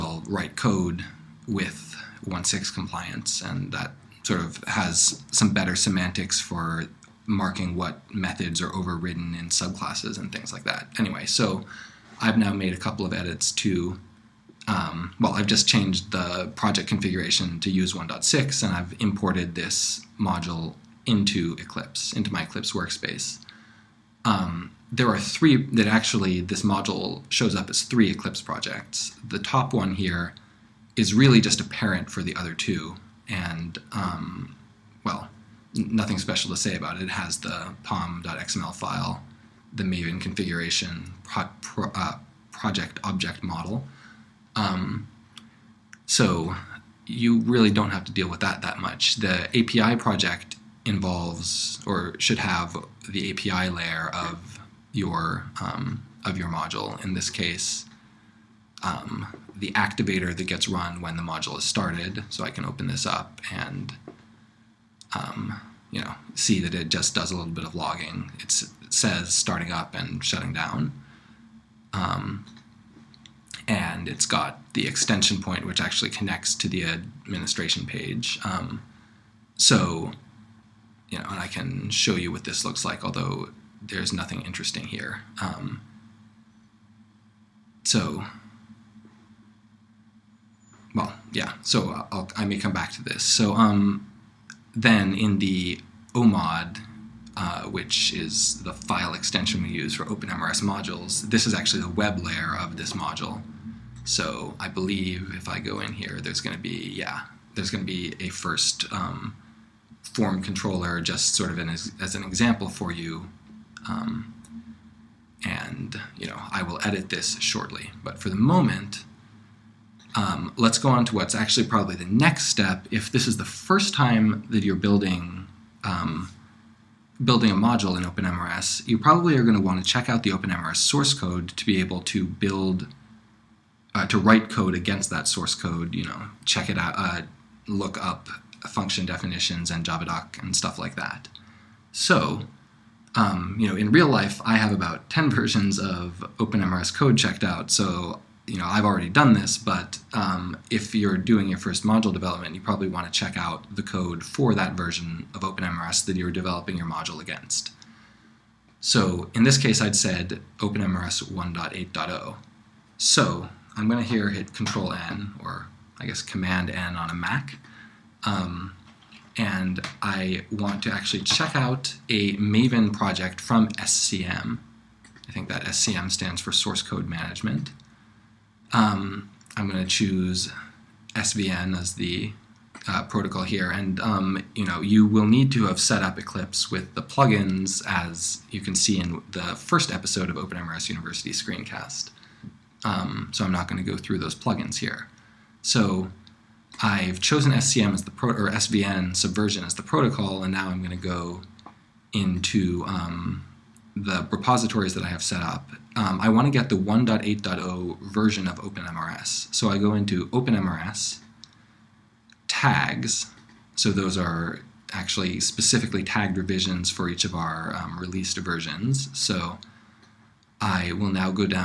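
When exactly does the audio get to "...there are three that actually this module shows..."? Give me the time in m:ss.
0:24.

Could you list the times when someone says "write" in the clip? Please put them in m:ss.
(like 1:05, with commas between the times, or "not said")
0:00, 2:14.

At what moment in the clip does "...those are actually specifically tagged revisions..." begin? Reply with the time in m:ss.
3:33.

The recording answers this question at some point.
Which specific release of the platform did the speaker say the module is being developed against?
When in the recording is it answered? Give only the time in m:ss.
2:40.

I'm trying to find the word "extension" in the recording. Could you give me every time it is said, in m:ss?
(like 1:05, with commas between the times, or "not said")
1:14, 1:39.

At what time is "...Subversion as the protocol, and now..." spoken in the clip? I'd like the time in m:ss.
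3:19.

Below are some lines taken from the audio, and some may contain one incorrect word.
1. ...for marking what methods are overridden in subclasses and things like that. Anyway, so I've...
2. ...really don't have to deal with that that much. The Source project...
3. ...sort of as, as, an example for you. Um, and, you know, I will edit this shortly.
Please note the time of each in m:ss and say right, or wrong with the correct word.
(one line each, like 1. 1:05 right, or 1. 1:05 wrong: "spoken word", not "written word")
1. 0:06 right
2. 0:47 wrong: "API", not "Source"
3. 1:51 right.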